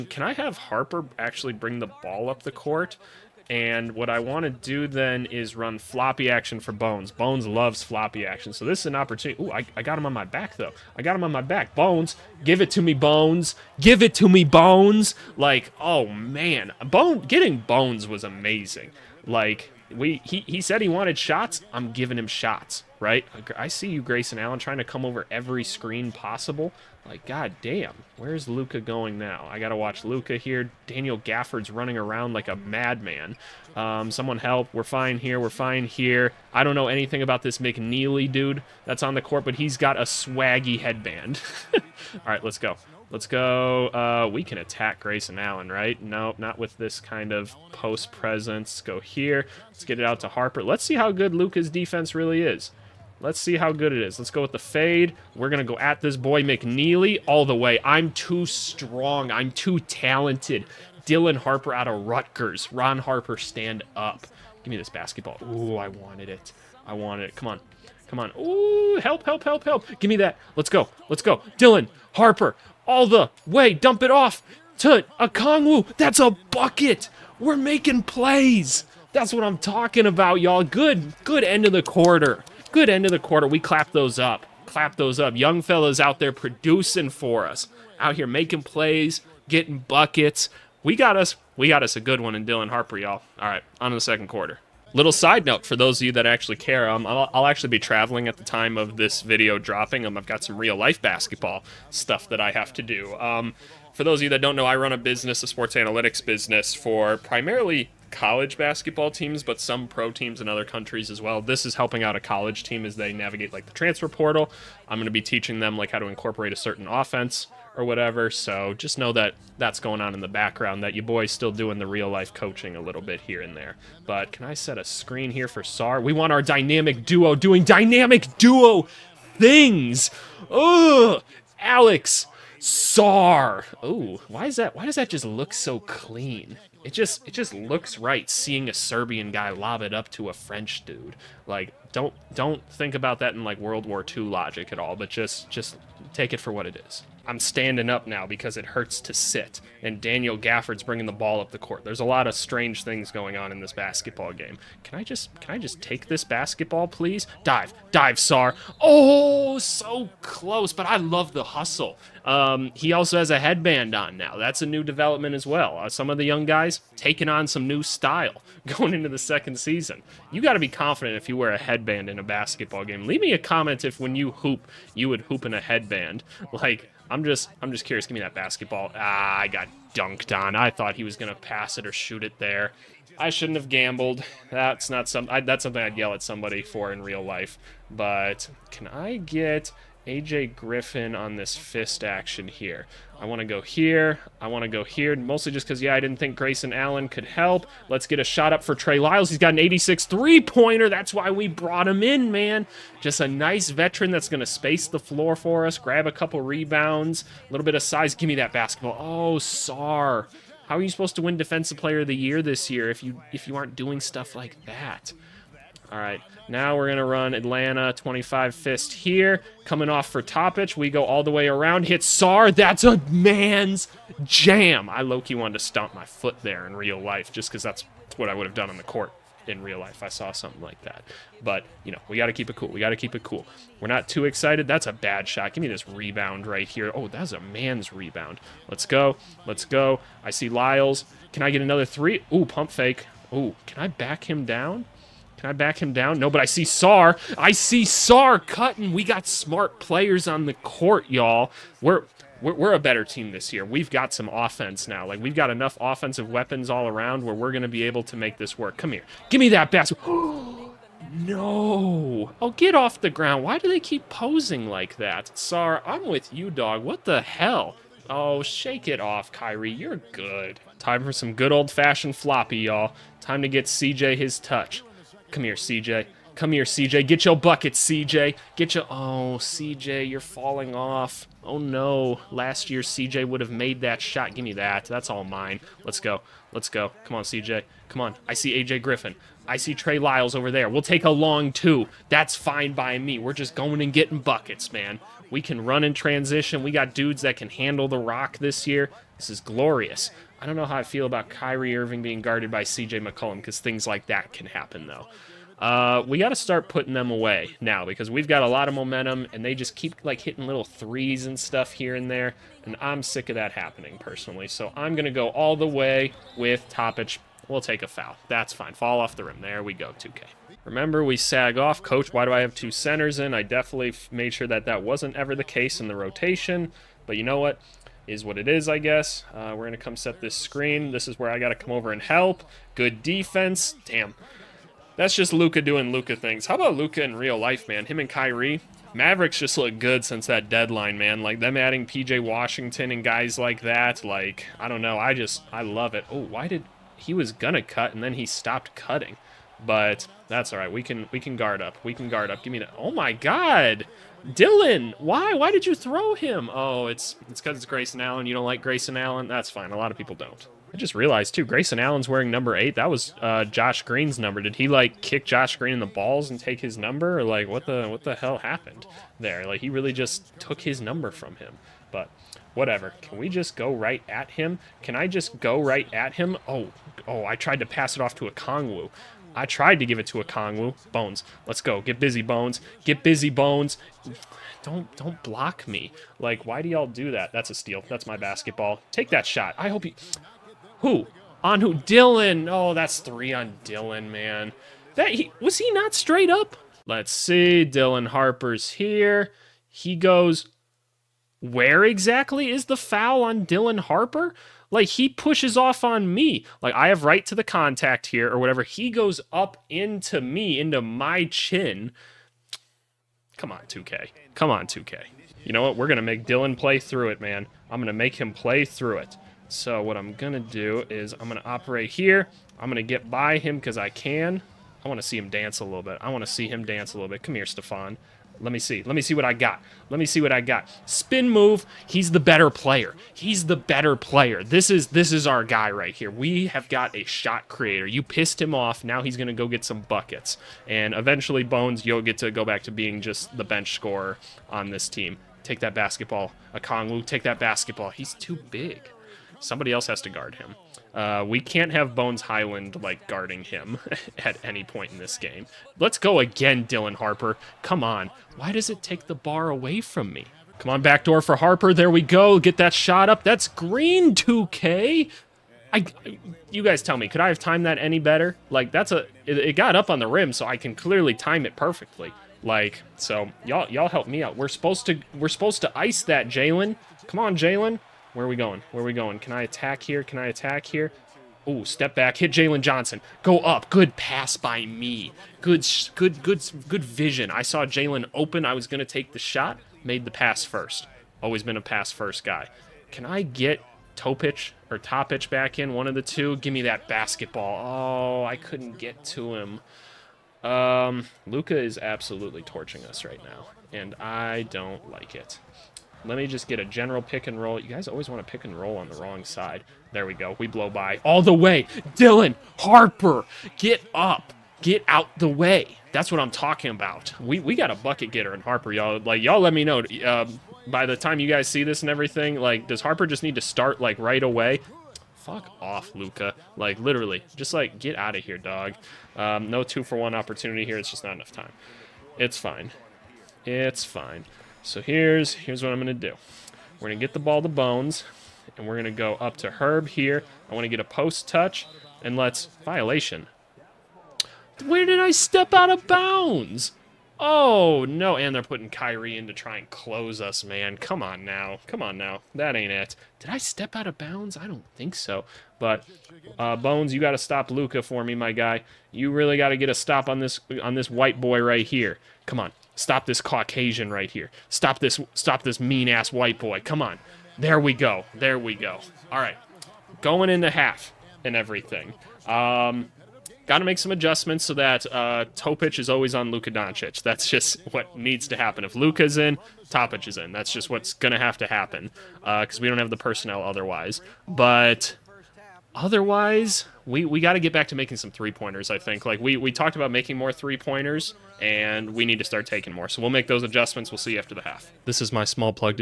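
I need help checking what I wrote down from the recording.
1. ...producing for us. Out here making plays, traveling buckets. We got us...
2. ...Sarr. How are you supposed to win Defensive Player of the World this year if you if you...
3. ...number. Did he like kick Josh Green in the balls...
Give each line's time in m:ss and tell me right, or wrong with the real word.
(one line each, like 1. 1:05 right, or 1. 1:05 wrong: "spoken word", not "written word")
1. 1:26 wrong: "getting", not "traveling"
2. 3:29 wrong: "Year", not "World"
3. 6:04 right.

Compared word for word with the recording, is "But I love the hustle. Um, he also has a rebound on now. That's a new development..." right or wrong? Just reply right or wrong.
wrong.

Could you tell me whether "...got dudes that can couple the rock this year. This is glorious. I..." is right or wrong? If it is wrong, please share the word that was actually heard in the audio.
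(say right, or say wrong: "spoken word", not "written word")
wrong: "handle", not "couple".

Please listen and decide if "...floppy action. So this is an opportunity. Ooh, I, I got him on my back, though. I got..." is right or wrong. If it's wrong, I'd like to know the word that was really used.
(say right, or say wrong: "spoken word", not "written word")
right.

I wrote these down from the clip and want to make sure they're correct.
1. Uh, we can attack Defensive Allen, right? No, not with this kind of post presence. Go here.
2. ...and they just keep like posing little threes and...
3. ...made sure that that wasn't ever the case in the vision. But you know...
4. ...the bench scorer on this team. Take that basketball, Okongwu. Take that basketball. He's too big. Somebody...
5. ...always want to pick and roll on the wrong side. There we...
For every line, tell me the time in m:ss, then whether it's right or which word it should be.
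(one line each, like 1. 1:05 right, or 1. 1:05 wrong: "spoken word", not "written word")
1. 0:43 wrong: "Grayson", not "Defensive"
2. 5:09 wrong: "hitting", not "posing"
3. 5:24 wrong: "rotation", not "vision"
4. 7:23 right
5. 8:27 right.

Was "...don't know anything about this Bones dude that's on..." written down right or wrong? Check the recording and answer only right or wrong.
wrong.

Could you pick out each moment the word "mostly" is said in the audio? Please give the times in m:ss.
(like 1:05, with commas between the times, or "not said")
3:15.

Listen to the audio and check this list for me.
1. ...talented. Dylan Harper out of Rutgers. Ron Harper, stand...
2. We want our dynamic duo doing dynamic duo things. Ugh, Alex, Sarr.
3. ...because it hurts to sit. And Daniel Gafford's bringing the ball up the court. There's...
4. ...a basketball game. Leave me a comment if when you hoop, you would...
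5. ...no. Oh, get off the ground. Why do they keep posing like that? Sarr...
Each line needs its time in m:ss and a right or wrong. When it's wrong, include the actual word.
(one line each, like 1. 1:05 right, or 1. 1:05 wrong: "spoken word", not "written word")
1. 0:59 right
2. 2:06 right
3. 2:28 right
4. 2:52 right
5. 4:20 right.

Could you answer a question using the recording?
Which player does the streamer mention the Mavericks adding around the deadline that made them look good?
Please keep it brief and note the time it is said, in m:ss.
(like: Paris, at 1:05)
PJ Washington, at 5:41.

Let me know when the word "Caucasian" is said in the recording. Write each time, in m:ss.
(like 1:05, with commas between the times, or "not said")
9:23.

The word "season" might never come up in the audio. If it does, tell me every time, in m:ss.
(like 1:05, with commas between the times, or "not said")
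2:49.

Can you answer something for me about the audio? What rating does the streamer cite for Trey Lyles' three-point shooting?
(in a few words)
86.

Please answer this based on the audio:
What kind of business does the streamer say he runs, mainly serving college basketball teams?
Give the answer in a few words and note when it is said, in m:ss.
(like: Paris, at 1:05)
sports analytics business, at 1:45.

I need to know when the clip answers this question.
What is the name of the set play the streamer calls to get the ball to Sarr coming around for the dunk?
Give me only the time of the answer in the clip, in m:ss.
3:37.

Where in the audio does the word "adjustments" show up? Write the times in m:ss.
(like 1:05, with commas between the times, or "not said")
9:33, 9:53.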